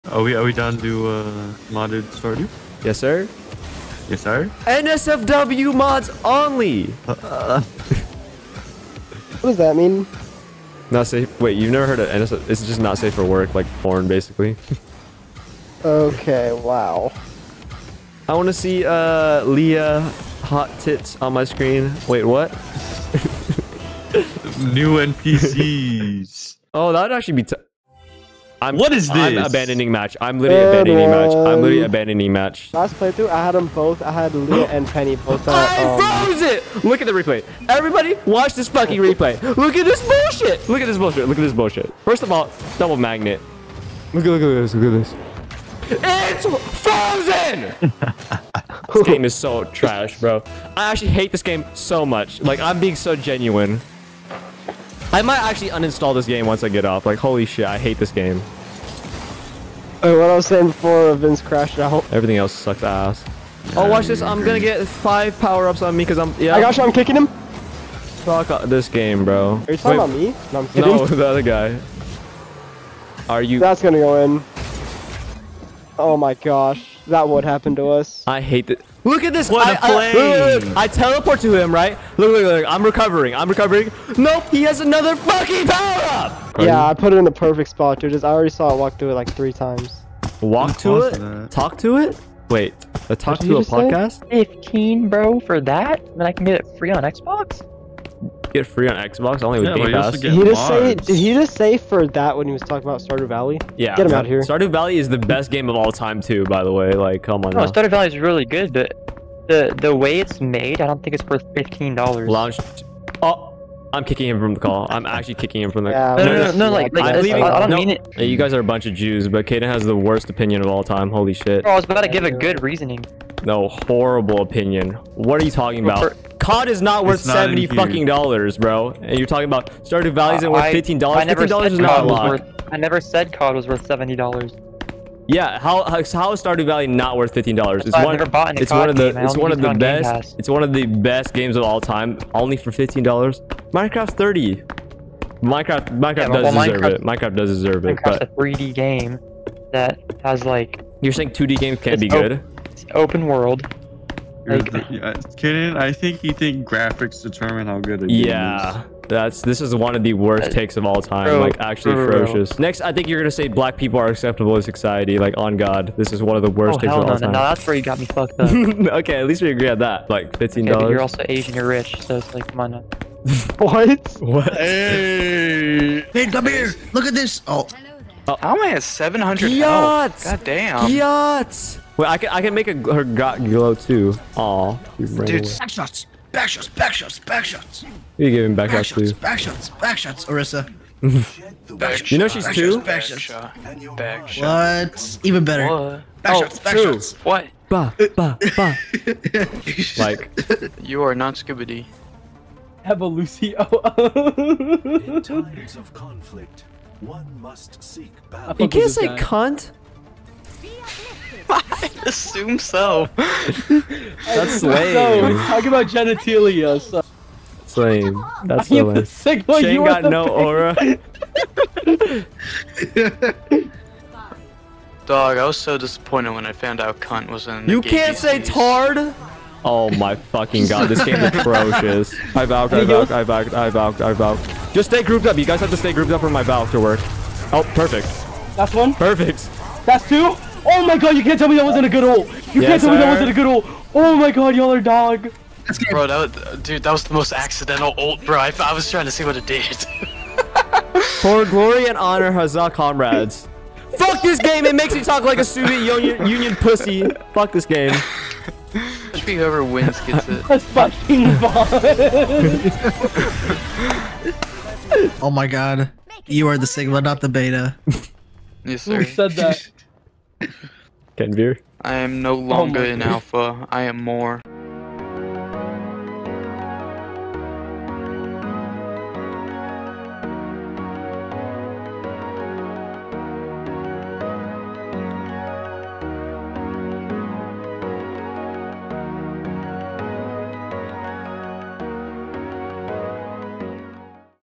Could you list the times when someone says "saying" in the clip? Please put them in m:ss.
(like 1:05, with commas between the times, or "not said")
1:00, 2:31.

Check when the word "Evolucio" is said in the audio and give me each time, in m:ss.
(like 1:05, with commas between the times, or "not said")
3:22.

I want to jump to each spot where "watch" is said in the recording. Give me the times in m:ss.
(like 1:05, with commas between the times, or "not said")
0:38, 1:03.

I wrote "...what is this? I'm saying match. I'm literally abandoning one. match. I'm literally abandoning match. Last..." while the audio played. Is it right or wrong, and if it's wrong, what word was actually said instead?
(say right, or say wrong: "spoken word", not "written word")
wrong: "abandoning", not "saying".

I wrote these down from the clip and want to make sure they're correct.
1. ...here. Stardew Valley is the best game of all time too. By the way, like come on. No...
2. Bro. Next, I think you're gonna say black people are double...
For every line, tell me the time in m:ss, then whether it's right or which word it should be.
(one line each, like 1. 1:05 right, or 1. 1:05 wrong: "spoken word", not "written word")
1. 1:44 right
2. 2:42 wrong: "acceptable", not "double".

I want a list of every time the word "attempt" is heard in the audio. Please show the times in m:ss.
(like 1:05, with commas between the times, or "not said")
not said.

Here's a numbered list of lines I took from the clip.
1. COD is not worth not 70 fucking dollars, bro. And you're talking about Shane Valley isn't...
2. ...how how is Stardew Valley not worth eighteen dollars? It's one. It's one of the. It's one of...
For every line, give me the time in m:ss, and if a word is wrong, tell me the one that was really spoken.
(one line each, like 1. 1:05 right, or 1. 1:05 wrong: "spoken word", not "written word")
1. 2:06 wrong: "Stardew", not "Shane"
2. 2:15 wrong: "fifteen", not "eighteen".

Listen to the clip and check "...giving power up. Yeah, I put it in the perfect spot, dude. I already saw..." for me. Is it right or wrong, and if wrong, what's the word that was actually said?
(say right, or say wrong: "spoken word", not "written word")
wrong: "fucking", not "giving".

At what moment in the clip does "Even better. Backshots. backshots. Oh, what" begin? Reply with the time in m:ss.
3:15.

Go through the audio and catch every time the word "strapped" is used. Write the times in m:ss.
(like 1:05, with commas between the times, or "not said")
not said.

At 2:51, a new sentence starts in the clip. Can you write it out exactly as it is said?
You're rich, so it's like come on.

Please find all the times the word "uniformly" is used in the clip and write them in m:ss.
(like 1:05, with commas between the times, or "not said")
not said.